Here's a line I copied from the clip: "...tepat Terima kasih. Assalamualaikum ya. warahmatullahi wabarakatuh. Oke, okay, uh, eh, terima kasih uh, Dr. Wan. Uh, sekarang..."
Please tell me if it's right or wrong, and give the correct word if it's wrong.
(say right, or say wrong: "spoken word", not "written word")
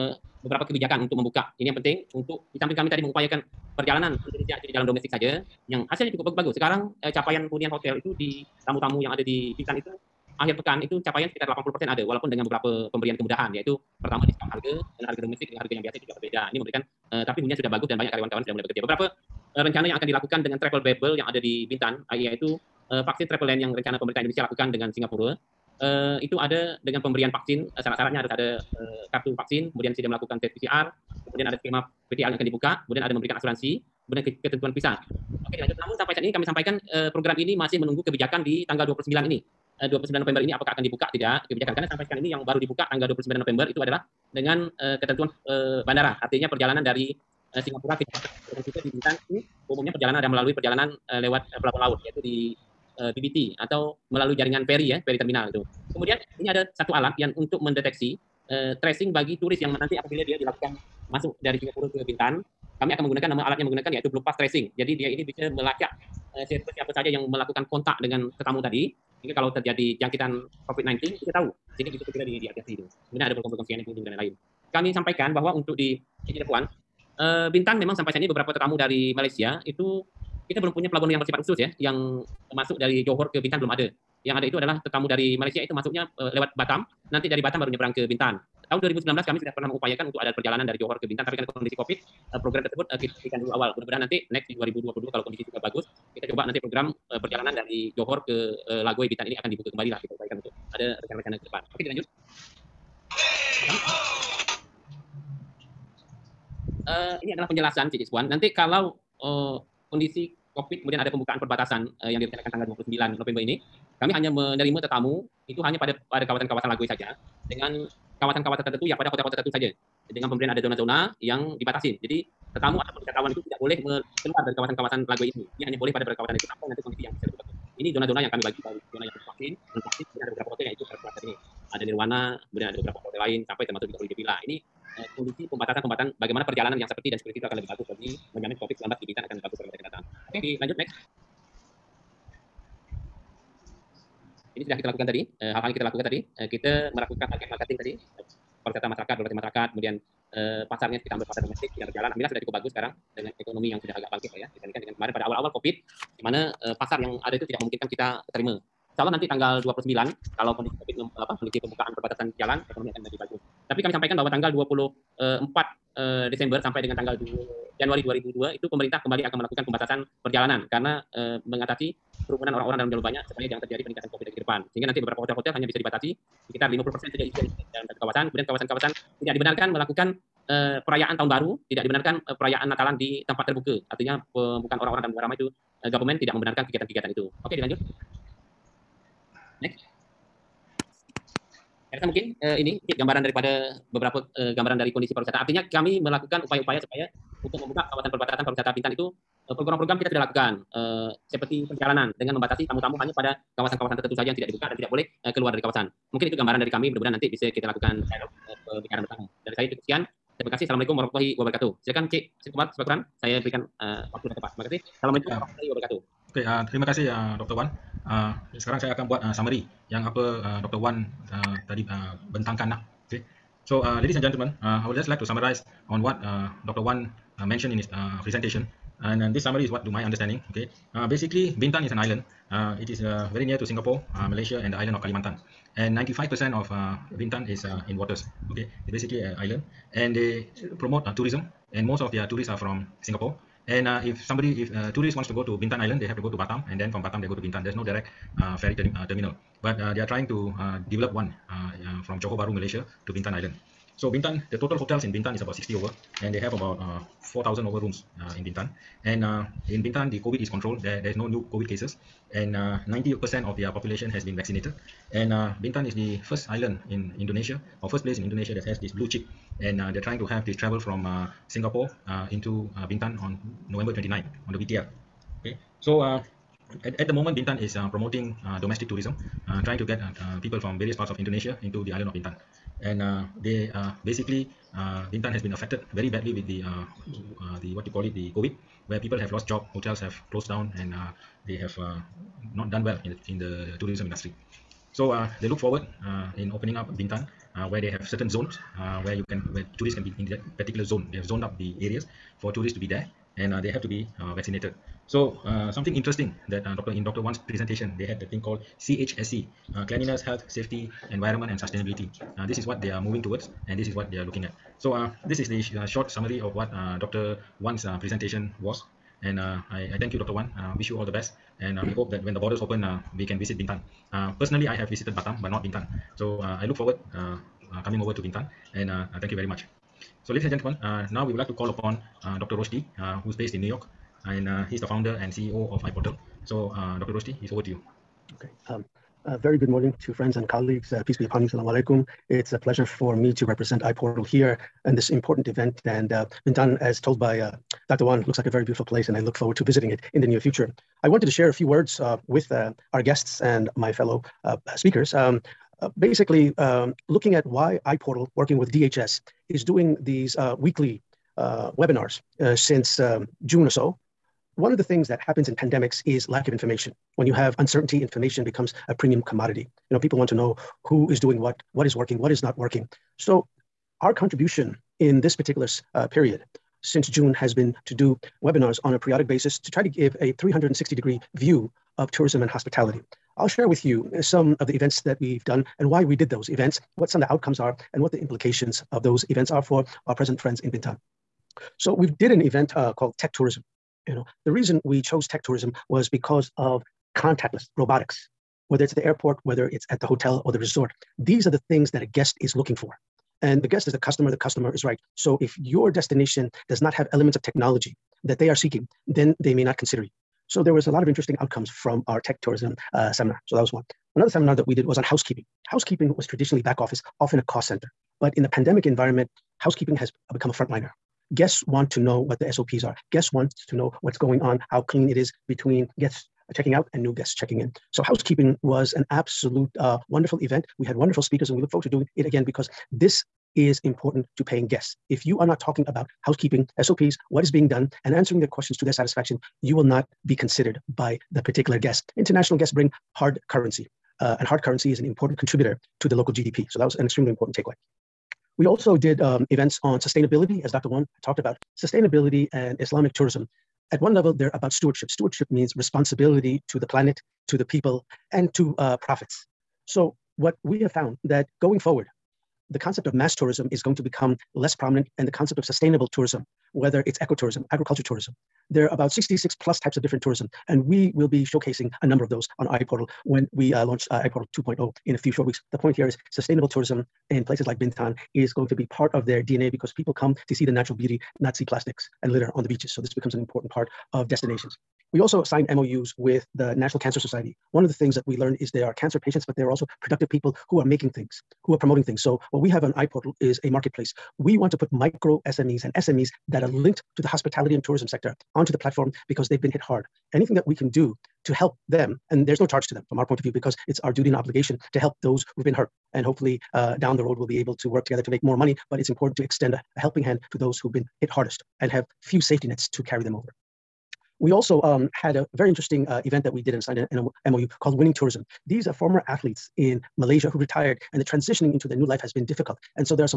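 right.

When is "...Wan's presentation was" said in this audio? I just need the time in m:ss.
5:17.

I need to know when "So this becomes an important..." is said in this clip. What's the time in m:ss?
8:02.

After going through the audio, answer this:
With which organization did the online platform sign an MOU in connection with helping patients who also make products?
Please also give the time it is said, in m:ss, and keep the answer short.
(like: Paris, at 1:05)
National Cancer Society, at 8:06.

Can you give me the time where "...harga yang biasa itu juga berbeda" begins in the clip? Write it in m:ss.
0:15.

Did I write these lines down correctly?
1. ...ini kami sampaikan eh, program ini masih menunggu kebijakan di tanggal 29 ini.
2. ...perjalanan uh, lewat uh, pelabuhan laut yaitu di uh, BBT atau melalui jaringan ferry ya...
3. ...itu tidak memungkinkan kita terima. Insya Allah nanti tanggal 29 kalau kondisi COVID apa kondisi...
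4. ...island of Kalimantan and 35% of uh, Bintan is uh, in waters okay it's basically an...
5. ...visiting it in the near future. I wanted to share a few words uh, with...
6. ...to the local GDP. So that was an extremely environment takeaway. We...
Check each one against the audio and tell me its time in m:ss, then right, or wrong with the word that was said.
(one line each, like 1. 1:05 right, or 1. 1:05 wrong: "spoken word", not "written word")
1. 0:36 right
2. 0:50 right
3. 2:37 right
4. 3:54 wrong: "95", not "35"
5. 5:49 right
6. 7:25 wrong: "important", not "environment".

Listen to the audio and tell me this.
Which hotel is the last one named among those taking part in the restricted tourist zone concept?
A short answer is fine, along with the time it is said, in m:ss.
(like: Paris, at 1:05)
Holiday Villa, at 2:13.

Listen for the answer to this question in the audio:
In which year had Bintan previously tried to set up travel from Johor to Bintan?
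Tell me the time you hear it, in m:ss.
1:28.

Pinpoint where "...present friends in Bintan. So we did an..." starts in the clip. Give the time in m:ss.
6:30.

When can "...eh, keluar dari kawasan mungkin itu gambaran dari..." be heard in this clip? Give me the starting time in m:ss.
3:25.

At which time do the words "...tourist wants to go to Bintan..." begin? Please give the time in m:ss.
4:04.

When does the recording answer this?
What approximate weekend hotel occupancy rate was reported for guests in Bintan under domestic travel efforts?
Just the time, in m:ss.
0:11.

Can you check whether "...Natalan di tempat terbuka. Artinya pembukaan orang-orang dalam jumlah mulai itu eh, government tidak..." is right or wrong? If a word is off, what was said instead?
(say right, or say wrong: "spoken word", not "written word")
wrong: "ramai", not "mulai".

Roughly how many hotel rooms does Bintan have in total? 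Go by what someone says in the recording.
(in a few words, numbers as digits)
4,000.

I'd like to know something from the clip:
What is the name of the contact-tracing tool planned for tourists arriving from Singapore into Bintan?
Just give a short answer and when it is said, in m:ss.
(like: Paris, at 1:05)
Blue Pass Tracing, at 1:04.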